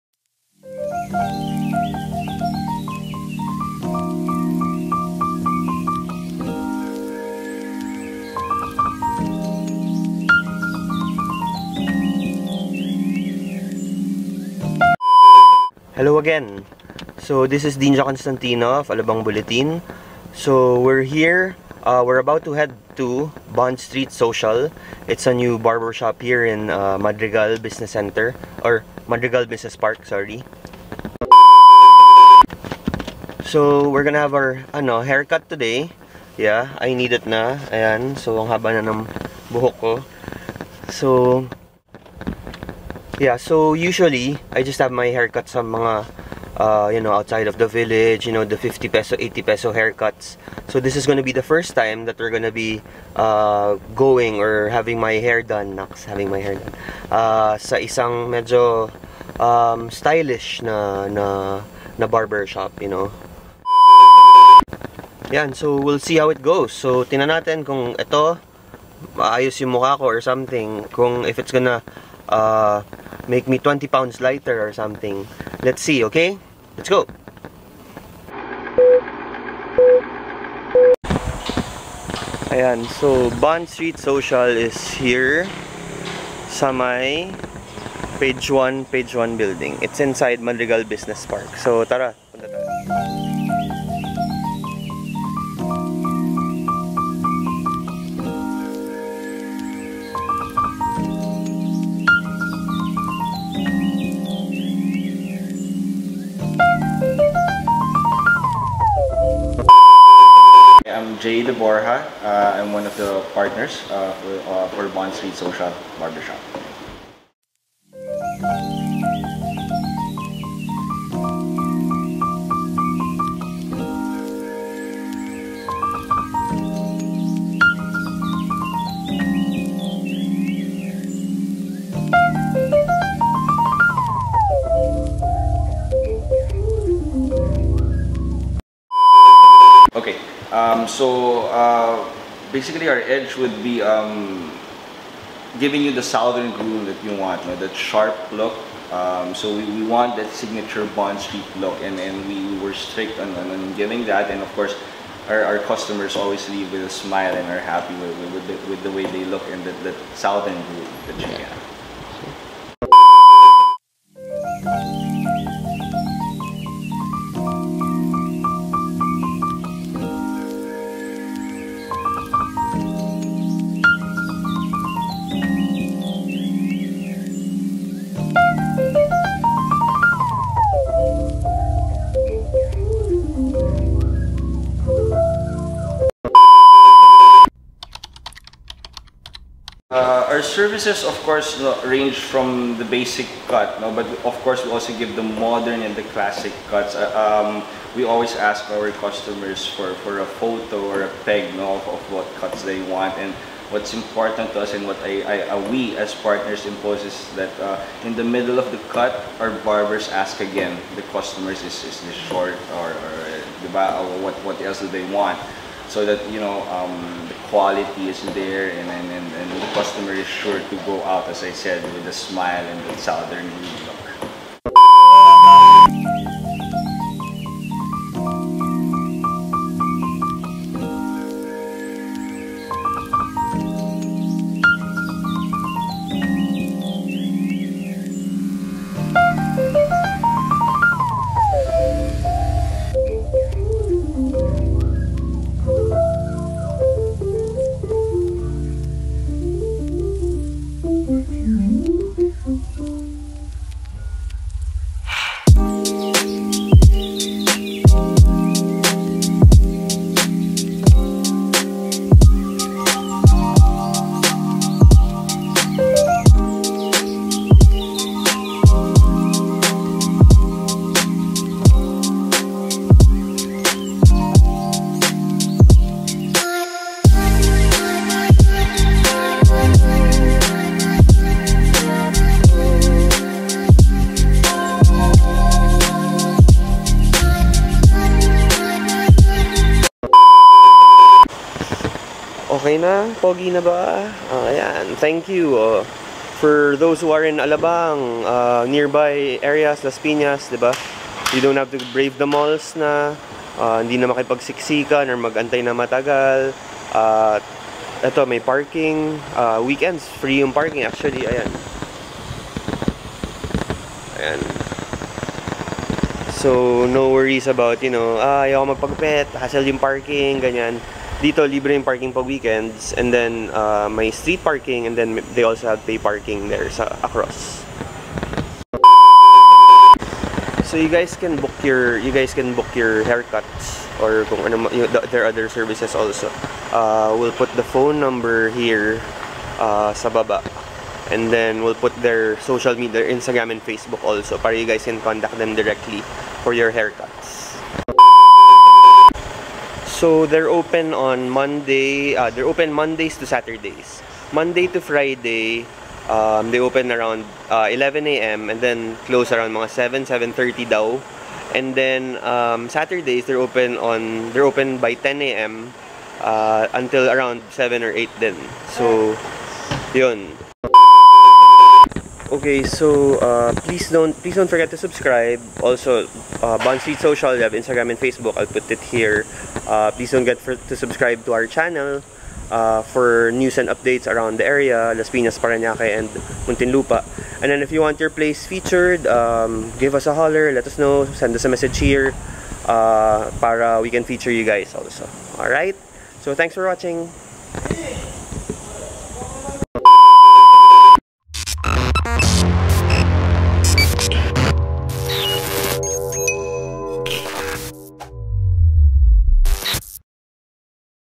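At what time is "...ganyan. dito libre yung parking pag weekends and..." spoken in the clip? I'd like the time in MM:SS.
05:20.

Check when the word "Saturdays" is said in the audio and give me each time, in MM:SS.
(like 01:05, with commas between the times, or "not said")
05:53, 06:02.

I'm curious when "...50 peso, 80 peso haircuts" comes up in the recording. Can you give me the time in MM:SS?
00:48.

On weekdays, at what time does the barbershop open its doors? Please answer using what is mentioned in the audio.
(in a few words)
11 a.m.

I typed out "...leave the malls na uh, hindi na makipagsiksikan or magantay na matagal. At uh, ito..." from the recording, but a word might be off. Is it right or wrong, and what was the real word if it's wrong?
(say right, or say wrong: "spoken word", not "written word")
wrong: "brave", not "leave".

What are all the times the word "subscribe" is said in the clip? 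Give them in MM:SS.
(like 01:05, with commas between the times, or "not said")
06:14, 06:20.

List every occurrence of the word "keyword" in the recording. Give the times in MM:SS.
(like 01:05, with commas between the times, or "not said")
not said.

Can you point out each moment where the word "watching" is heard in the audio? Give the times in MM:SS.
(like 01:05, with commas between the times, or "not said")
06:36.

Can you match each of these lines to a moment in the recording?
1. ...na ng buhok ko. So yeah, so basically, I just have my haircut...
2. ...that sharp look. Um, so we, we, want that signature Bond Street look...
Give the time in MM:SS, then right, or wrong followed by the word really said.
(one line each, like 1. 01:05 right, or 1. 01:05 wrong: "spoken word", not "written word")
1. 00:38 wrong: "usually", not "basically"
2. 02:27 right.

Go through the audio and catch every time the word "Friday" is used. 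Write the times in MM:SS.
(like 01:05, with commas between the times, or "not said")
05:54.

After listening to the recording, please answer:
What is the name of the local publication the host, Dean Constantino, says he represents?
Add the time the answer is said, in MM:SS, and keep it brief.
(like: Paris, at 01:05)
Alabang Bulletin, at 00:18.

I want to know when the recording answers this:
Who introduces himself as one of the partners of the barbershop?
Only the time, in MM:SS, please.
01:51.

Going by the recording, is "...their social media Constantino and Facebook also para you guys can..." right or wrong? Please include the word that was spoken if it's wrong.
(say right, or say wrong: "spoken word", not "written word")
wrong: "Instagram", not "Constantino".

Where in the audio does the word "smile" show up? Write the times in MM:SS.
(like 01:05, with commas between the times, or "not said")
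02:36, 03:42.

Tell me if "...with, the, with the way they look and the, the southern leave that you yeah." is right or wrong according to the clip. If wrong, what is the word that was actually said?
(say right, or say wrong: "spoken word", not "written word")
wrong: "groove", not "leave".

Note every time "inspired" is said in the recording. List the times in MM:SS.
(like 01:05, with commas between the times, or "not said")
not said.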